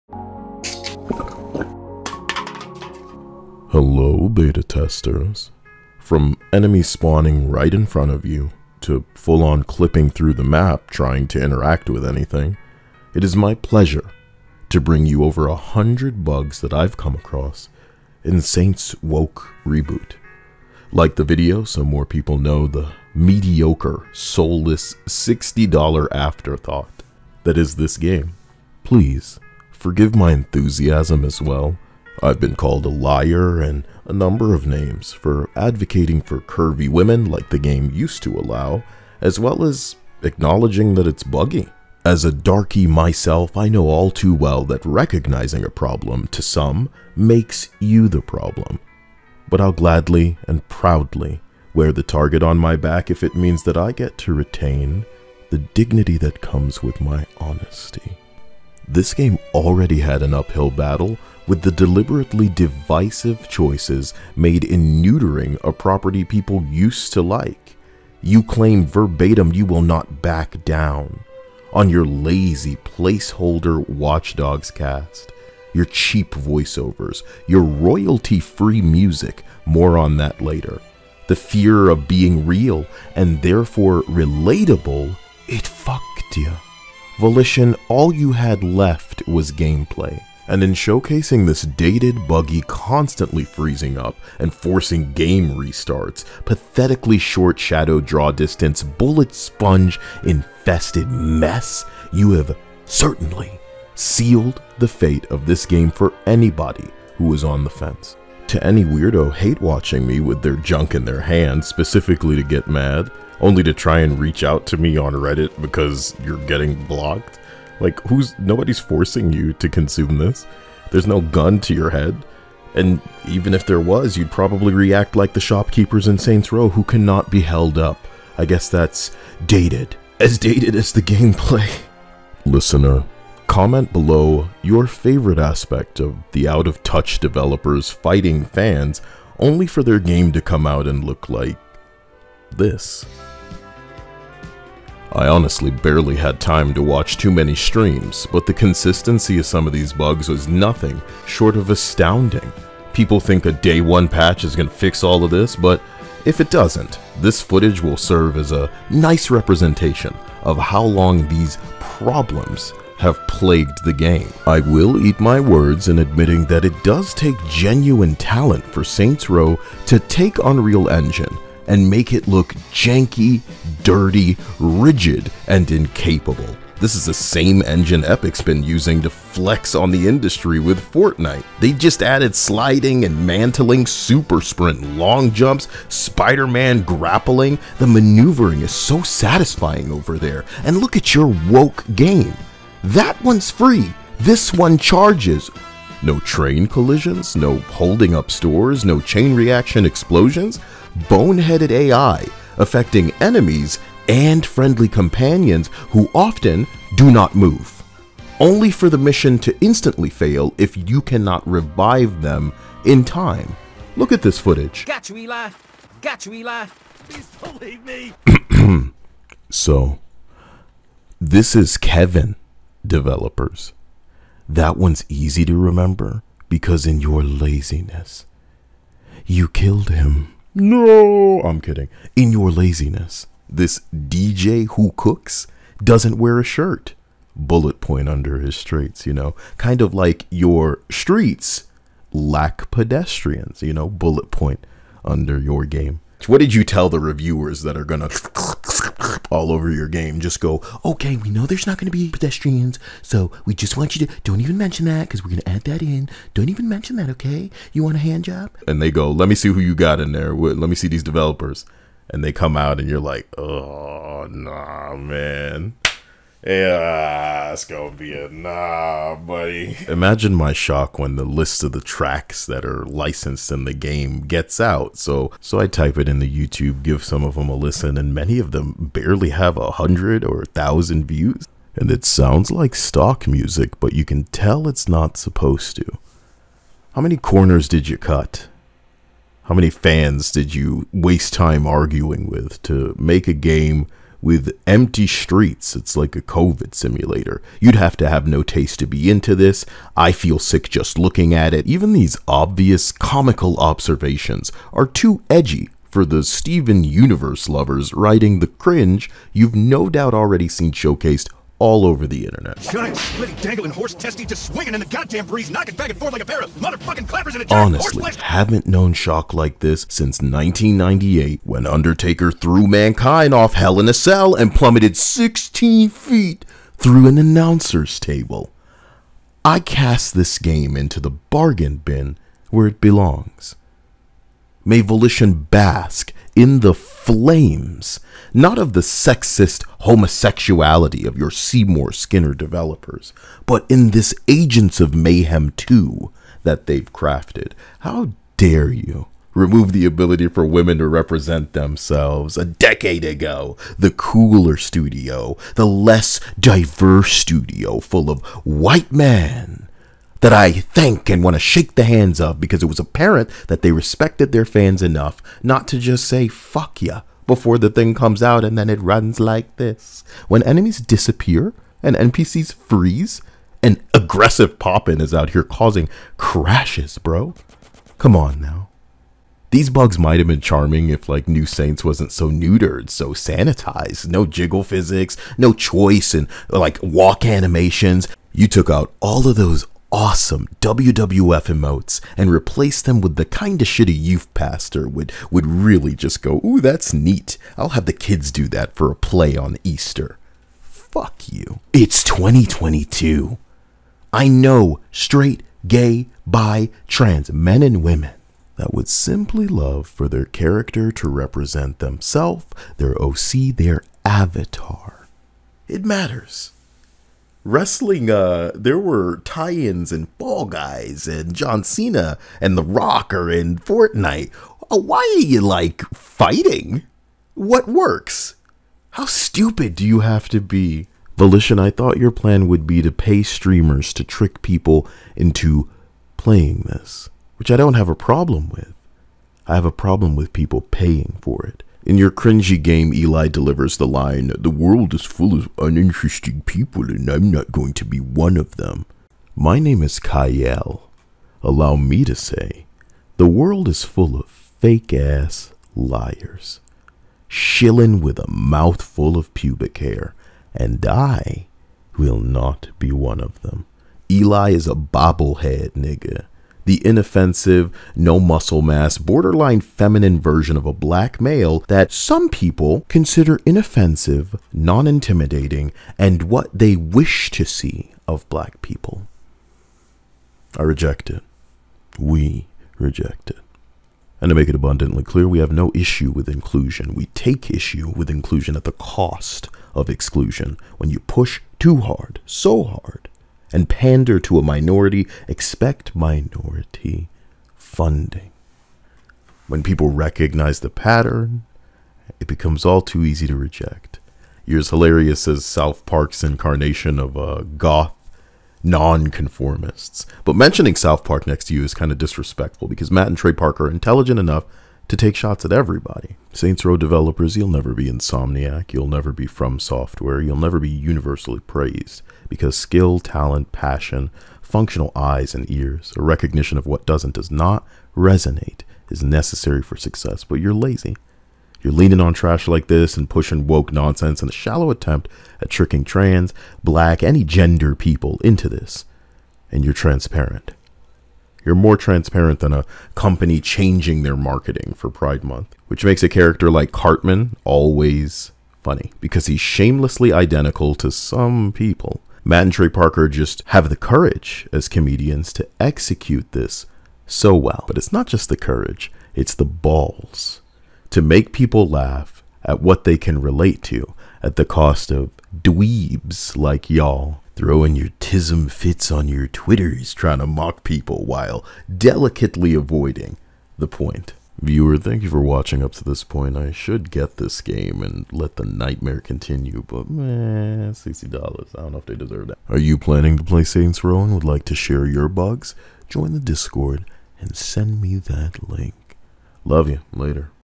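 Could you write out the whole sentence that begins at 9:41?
I don't know if they deserve that.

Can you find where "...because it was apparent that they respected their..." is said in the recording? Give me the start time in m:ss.
6:02.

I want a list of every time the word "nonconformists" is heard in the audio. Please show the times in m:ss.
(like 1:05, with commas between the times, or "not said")
8:28.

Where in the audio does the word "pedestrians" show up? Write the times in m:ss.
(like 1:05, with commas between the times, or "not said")
4:02, 4:12.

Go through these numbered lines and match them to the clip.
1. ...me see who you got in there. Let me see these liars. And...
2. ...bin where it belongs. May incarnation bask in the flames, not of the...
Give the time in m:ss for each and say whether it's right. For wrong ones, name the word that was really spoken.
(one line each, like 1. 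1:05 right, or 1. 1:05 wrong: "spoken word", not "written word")
1. 4:19 wrong: "developers", not "liars"
2. 5:31 wrong: "volition", not "incarnation".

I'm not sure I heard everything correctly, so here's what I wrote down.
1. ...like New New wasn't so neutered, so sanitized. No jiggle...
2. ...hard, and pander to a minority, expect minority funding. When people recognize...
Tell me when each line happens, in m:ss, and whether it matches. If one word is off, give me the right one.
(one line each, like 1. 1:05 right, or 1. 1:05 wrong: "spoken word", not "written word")
1. 6:21 wrong: "Saints", not "New"
2. 8:12 right.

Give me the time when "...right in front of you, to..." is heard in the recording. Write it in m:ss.
0:07.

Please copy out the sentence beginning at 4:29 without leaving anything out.
Imagine my shock when the list of the tracks that are licensed in the game gets out.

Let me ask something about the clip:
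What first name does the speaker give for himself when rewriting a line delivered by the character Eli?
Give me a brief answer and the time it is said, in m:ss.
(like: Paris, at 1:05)
Kyle, at 7:29.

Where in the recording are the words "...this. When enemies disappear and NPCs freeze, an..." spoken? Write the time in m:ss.
6:09.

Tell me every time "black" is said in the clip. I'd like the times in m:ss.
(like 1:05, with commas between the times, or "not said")
7:50, 7:58, 8:56.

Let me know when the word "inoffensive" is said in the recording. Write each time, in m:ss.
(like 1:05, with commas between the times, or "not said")
7:46, 7:53.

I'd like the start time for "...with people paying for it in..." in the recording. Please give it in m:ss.
7:20.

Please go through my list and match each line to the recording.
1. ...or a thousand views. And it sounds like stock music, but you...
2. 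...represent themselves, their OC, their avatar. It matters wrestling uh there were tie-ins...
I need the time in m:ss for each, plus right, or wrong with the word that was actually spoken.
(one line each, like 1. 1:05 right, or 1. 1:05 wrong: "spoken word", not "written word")
1. 4:40 right
2. 6:51 right.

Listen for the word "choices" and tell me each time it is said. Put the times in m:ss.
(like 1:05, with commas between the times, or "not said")
1:03, 6:25.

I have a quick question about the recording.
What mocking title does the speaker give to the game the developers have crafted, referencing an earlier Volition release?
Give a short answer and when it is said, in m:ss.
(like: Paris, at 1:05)
Agents of Mayhem 2, at 5:44.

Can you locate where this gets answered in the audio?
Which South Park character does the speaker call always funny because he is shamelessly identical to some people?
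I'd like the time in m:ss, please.
9:06.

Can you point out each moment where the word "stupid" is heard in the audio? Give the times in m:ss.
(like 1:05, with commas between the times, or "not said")
7:09.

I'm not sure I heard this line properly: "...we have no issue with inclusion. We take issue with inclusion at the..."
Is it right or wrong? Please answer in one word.
right.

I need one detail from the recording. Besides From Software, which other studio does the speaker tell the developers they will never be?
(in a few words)
Insomniac.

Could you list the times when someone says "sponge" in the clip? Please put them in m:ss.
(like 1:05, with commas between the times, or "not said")
1:39.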